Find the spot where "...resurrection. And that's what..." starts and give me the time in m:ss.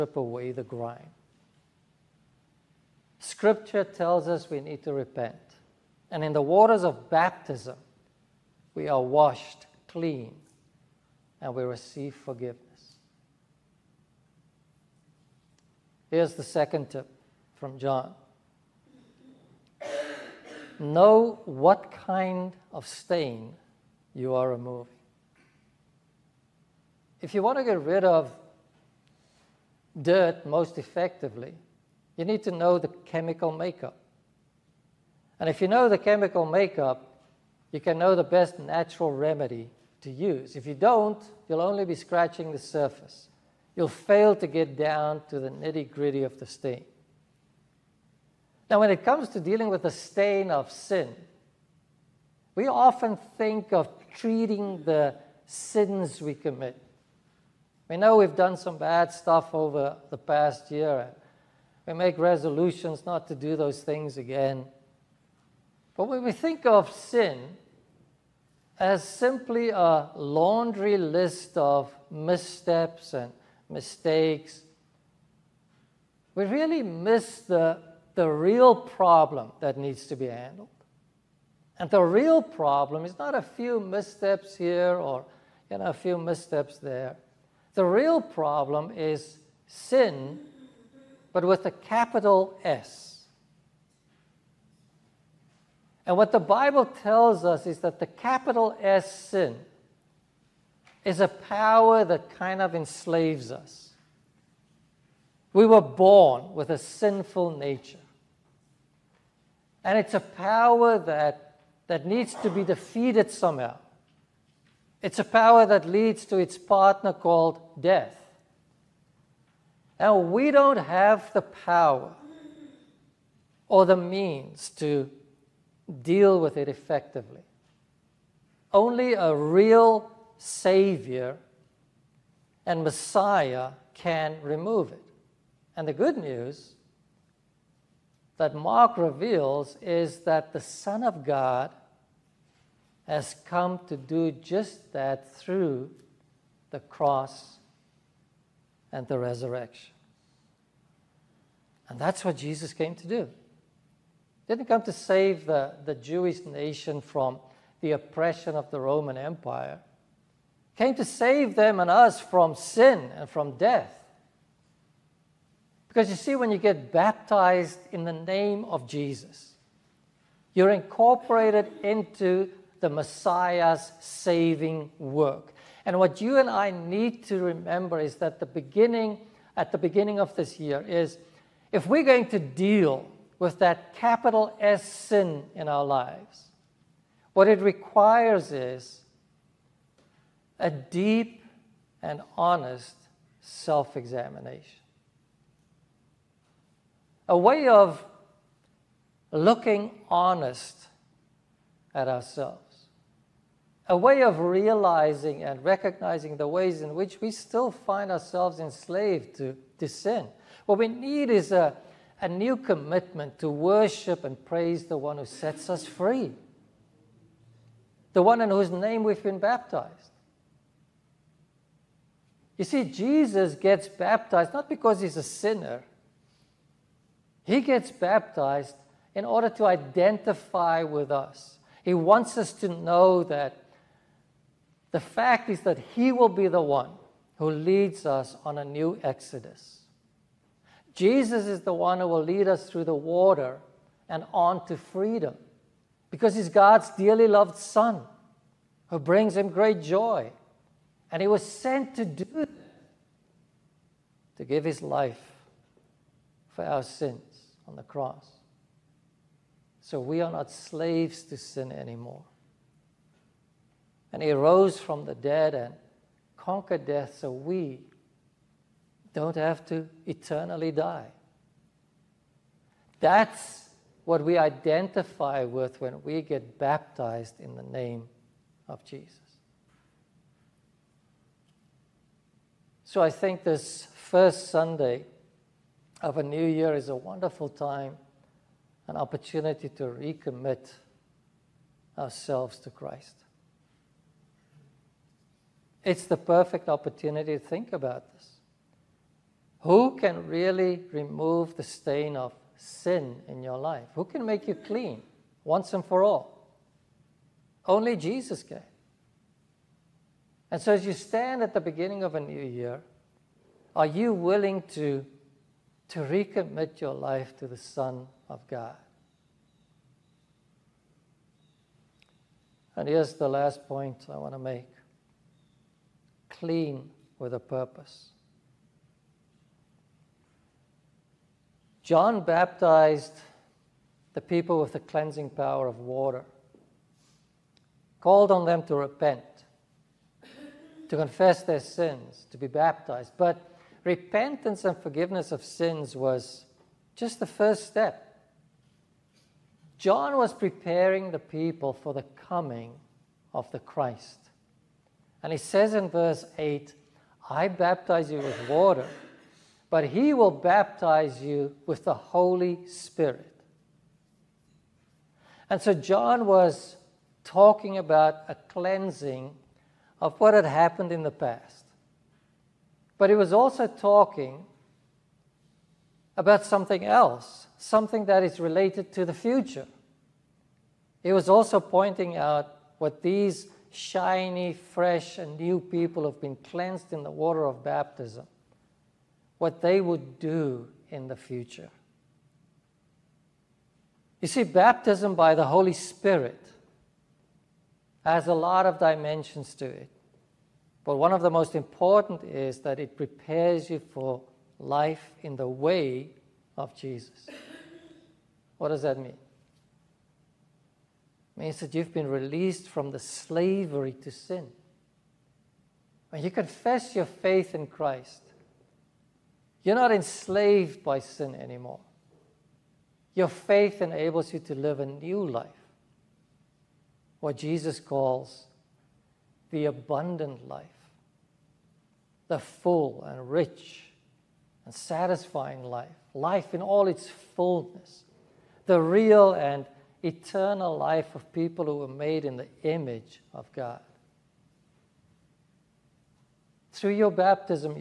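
2:29.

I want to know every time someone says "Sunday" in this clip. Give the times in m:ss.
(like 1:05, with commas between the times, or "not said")
4:44.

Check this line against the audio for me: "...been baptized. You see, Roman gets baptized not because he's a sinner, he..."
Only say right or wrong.
wrong.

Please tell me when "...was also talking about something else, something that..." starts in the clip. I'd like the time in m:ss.
6:13.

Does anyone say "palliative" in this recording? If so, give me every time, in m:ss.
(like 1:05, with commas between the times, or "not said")
not said.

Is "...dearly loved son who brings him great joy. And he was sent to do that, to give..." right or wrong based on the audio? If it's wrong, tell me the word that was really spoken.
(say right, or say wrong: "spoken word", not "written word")
right.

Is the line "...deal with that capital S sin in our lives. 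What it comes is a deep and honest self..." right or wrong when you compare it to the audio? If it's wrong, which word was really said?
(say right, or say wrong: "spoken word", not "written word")
wrong: "requires", not "comes".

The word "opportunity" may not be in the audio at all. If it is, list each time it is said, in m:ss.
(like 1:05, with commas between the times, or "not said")
4:48, 4:56.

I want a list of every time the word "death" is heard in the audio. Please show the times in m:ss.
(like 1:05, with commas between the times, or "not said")
1:57, 2:43, 4:26.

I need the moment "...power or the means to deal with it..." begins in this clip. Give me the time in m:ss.
2:01.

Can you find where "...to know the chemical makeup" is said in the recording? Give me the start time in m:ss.
0:32.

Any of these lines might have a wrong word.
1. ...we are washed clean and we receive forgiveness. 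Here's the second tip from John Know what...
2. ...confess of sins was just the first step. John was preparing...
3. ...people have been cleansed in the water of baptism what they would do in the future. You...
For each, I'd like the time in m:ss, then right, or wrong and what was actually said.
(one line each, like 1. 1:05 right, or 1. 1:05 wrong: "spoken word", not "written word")
1. 0:08 right
2. 5:44 wrong: "forgiveness", not "confess"
3. 6:25 right.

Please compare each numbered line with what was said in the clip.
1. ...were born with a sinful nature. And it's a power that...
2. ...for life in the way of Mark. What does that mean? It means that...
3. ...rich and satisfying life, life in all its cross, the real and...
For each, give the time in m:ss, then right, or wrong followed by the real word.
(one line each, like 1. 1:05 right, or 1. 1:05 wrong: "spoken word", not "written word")
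1. 1:45 right
2. 6:43 wrong: "Jesus", not "Mark"
3. 7:13 wrong: "fullness", not "cross".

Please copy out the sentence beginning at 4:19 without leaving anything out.
So we are not slaves to sin anymore.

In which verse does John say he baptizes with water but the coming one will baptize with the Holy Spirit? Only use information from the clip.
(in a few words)
Verse 8.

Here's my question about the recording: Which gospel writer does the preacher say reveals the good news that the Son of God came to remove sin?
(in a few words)
Mark.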